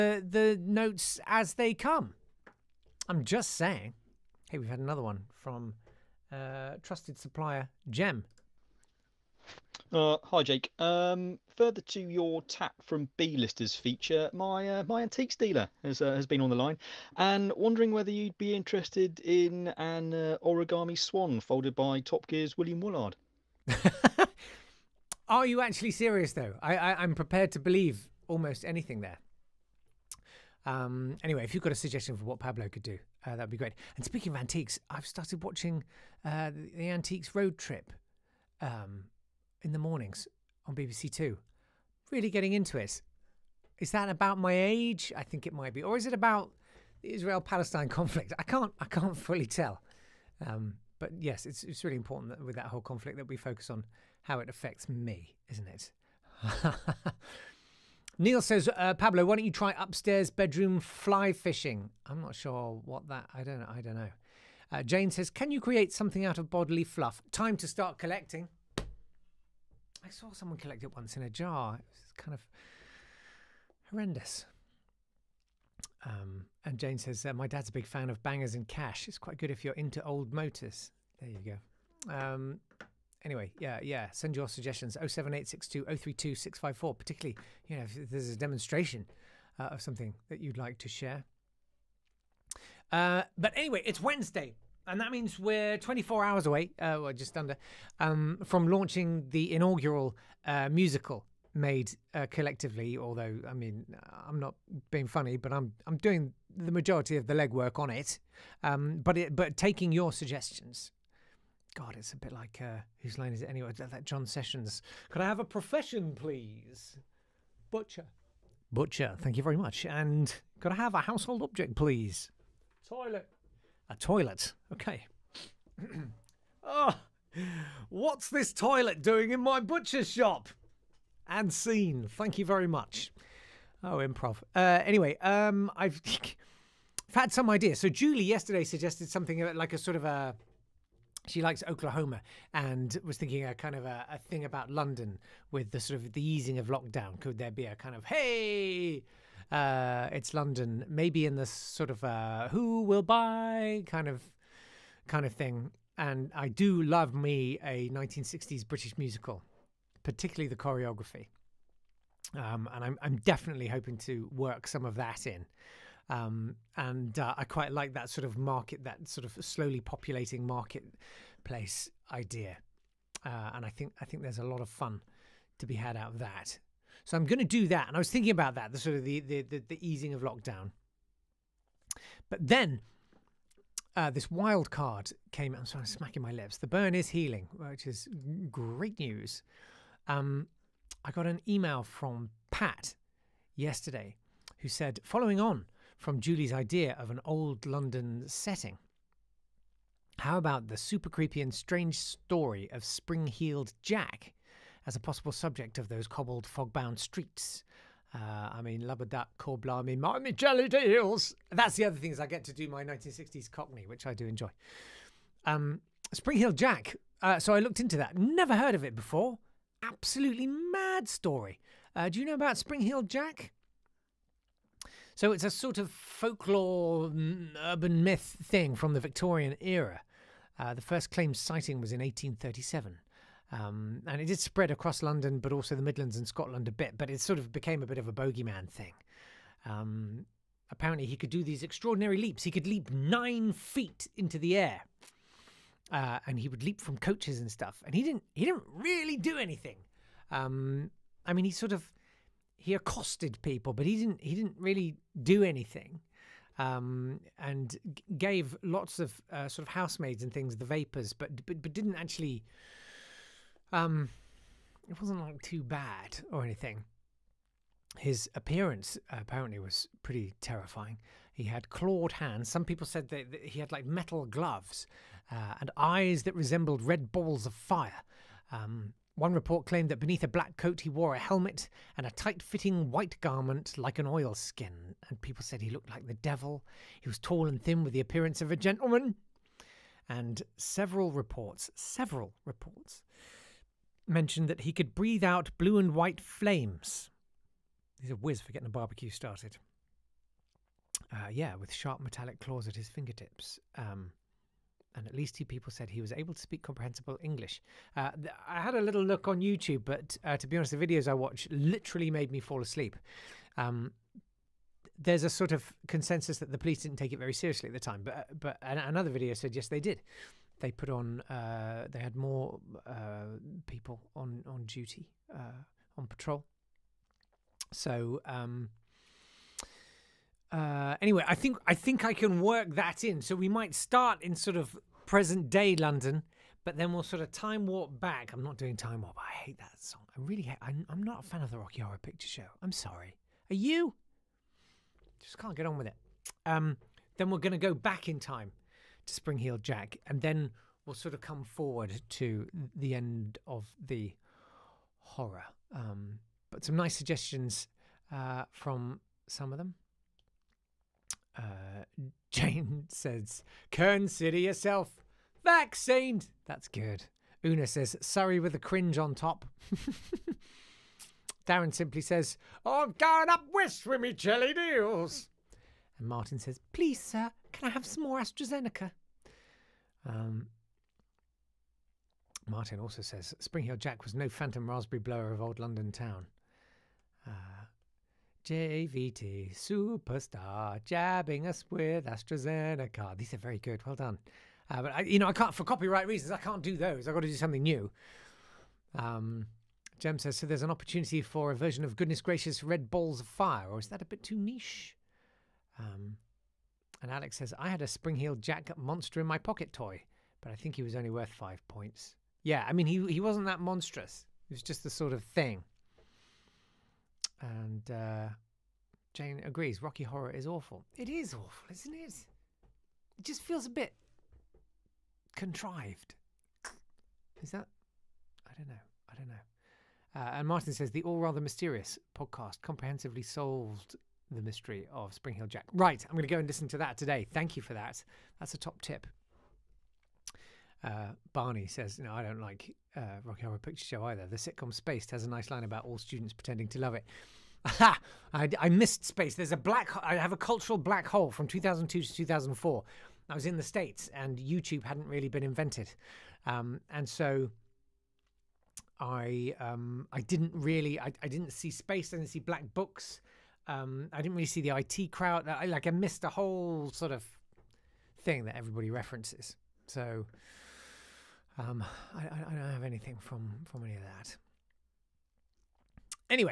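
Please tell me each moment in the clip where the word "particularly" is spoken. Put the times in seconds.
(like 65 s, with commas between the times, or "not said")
86 s, 160 s.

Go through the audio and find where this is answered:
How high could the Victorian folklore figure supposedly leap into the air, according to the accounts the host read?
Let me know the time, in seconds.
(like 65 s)
242 s.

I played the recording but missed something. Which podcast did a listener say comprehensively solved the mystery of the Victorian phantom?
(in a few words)
All Rather Mysterious.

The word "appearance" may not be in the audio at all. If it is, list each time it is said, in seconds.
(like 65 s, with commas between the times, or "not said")
268 s, 287 s.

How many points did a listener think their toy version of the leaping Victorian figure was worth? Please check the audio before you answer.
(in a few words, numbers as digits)
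5.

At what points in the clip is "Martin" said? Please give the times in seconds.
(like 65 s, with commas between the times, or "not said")
376 s, 382 s, 430 s.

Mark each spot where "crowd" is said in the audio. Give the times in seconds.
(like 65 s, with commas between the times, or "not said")
465 s.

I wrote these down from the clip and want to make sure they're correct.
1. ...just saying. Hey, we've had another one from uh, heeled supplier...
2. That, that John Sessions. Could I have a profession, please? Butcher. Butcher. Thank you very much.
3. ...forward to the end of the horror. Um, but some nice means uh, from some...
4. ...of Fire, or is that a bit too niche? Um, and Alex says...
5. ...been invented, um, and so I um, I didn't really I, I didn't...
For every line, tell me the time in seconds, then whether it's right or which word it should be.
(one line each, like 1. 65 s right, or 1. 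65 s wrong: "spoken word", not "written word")
1. 3 s wrong: "trusted", not "heeled"
2. 113 s right
3. 351 s wrong: "suggestions", not "means"
4. 403 s right
5. 455 s right.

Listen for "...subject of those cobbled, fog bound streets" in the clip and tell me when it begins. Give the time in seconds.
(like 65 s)
205 s.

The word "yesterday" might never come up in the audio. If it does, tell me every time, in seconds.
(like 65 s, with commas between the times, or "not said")
138 s, 193 s.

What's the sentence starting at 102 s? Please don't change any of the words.
Although, I mean, I'm not being funny, but I'm I'm doing the majority of the legwork on it.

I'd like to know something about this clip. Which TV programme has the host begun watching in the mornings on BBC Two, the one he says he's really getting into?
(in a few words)
Antiques Road Trip.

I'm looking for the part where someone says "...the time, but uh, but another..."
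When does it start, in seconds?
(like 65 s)
317 s.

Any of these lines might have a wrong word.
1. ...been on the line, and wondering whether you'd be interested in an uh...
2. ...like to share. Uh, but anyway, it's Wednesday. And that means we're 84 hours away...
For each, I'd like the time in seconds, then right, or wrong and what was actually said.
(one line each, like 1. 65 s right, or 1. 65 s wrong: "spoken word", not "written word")
1. 16 s right
2. 90 s wrong: "24", not "84".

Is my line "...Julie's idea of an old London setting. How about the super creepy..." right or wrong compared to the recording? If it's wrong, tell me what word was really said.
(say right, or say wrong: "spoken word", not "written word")
right.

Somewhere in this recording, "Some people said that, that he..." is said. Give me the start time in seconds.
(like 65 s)
272 s.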